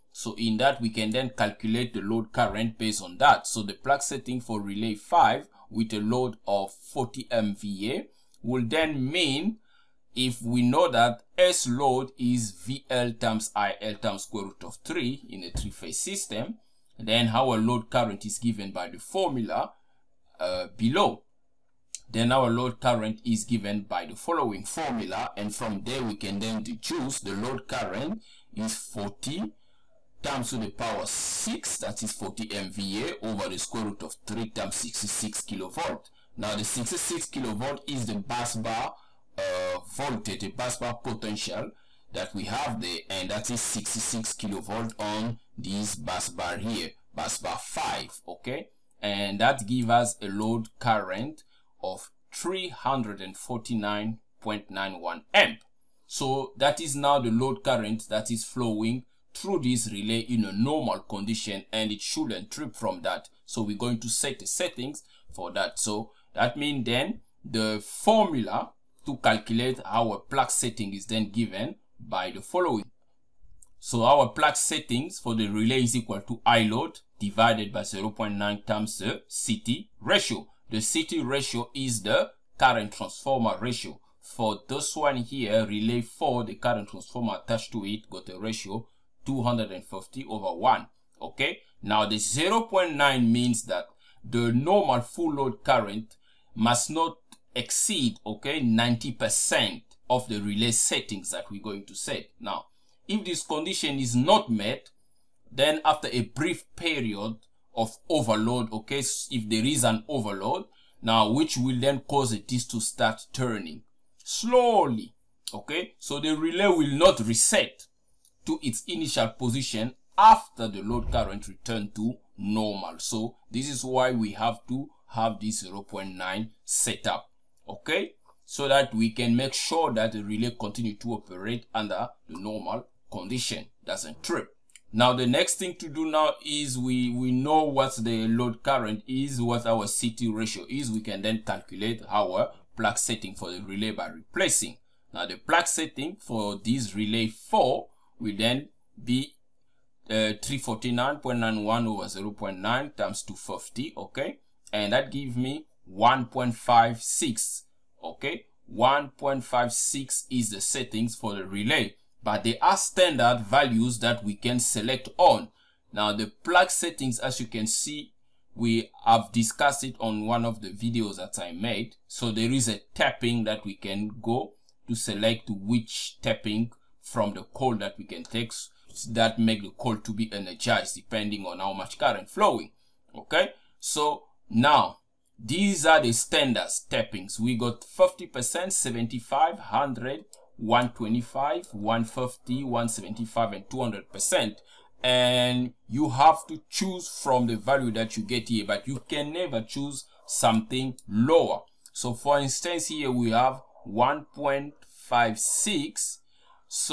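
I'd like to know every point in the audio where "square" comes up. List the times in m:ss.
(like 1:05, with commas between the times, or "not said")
0:14, 0:33.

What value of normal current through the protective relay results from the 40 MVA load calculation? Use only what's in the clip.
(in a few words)
349.91 A.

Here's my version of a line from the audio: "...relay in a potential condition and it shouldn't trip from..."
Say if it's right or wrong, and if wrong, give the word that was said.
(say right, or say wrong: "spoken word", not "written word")
wrong: "normal", not "potential".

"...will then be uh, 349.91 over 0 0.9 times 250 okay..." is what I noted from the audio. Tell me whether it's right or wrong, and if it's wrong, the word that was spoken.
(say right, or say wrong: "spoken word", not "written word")
right.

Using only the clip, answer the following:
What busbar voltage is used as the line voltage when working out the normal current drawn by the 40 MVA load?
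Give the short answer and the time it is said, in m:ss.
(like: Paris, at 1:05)
66 kV, at 0:43.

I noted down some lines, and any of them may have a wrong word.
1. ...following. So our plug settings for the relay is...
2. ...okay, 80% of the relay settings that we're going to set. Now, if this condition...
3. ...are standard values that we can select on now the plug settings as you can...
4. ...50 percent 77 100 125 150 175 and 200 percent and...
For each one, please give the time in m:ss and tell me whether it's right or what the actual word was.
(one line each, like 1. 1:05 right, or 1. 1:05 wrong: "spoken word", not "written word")
1. 1:12 right
2. 1:38 wrong: "90", not "80"
3. 2:42 right
4. 3:07 wrong: "75", not "77".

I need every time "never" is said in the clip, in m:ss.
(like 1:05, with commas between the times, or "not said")
3:19.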